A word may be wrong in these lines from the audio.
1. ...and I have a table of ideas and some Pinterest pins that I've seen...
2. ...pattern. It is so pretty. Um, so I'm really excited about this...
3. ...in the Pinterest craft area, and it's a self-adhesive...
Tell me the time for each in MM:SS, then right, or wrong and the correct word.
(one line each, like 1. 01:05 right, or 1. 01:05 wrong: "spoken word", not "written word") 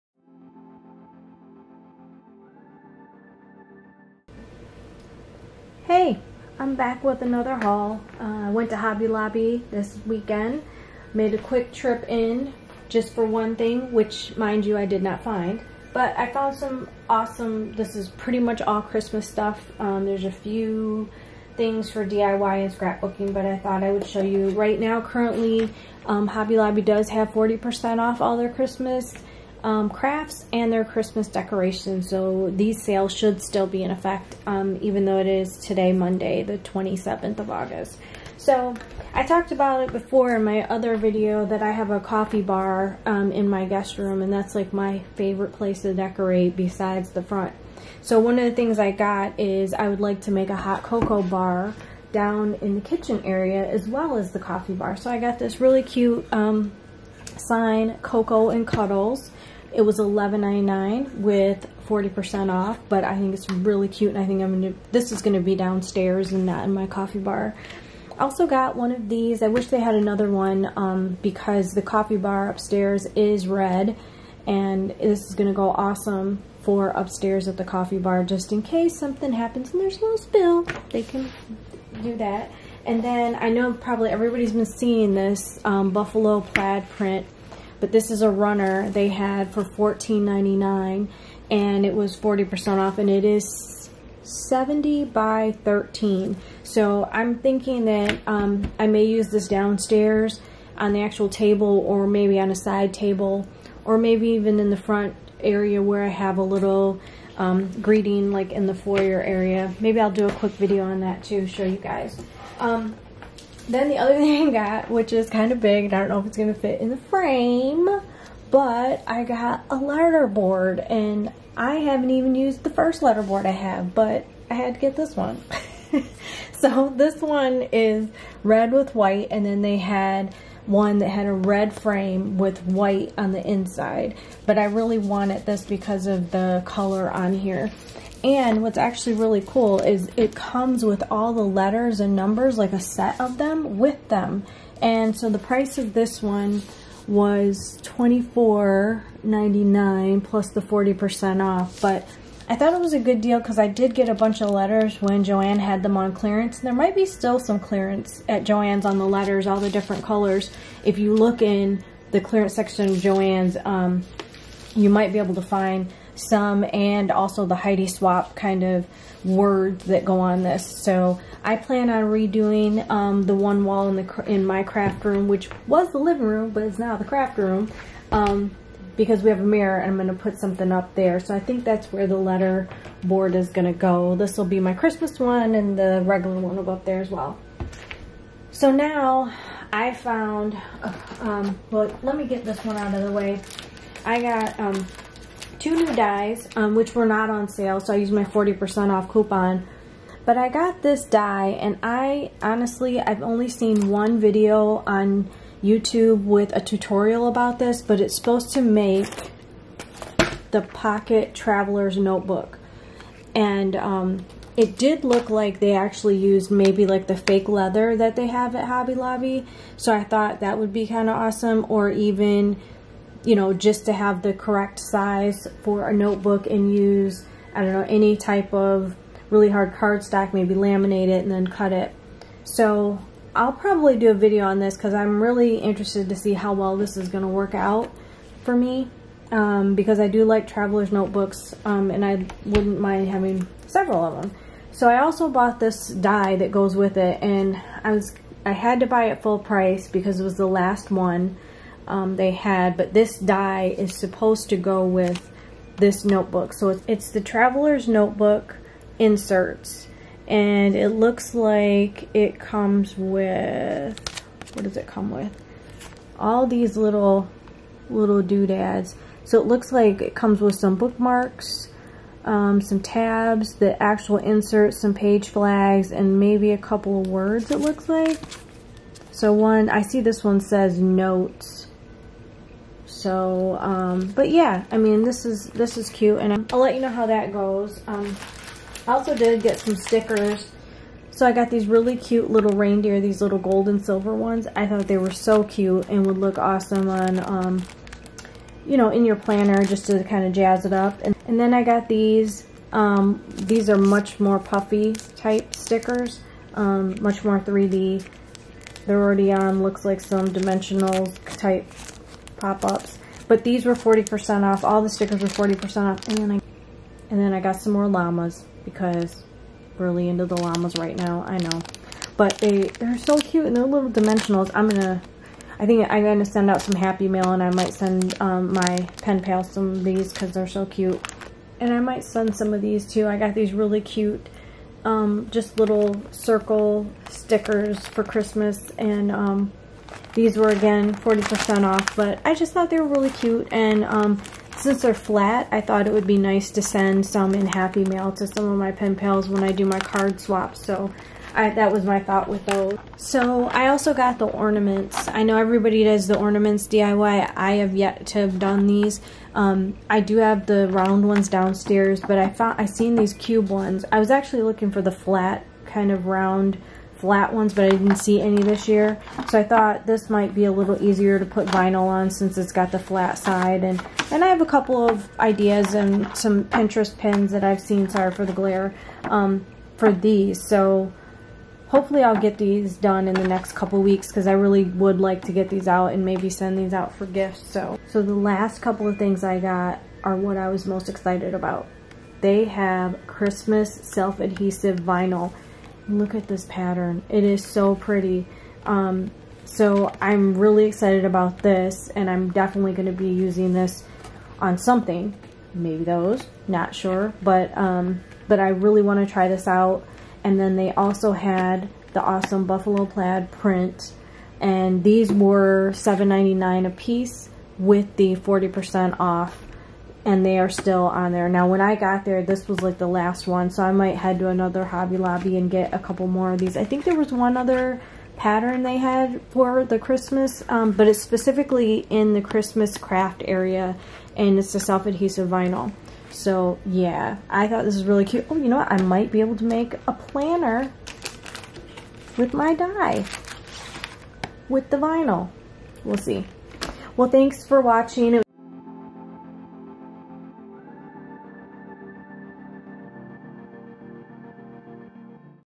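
1. 06:14 wrong: "couple", not "table"
2. 06:36 right
3. 07:11 wrong: "Christmas", not "Pinterest".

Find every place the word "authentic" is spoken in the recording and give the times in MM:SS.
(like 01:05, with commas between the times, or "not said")
not said.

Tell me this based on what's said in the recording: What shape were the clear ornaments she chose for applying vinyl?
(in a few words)
cube.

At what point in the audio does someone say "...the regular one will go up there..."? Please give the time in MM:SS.
03:05.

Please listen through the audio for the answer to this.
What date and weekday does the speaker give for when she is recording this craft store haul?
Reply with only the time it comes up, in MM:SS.
00:35.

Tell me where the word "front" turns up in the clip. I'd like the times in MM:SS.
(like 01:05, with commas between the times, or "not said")
00:47, 01:44.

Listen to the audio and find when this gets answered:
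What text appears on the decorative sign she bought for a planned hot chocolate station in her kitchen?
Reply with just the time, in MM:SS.
00:58.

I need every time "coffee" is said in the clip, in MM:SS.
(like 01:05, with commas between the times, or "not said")
00:41, 00:54, 01:06, 01:11, 01:17.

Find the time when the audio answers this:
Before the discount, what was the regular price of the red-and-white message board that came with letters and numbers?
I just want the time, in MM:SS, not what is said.
02:27.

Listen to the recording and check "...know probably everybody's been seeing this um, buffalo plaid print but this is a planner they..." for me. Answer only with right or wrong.
wrong.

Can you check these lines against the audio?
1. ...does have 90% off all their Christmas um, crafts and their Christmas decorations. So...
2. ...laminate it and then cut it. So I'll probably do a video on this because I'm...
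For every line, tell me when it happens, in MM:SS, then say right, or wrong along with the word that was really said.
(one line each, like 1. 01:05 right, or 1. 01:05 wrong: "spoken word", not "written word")
1. 00:26 wrong: "40", not "90"
2. 03:50 right.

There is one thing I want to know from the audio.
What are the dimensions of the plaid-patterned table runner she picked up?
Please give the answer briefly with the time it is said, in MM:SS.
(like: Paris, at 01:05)
70 by 13, at 01:34.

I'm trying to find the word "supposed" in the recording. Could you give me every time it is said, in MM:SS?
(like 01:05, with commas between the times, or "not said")
03:28, 04:13.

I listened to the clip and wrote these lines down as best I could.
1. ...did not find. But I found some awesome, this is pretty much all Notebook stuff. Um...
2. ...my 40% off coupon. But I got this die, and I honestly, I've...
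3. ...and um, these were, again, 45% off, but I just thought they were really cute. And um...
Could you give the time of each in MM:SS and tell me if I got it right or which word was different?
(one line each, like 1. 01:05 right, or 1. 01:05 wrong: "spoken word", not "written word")
1. 00:14 wrong: "Christmas", not "Notebook"
2. 03:18 right
3. 05:38 wrong: "40", not "45".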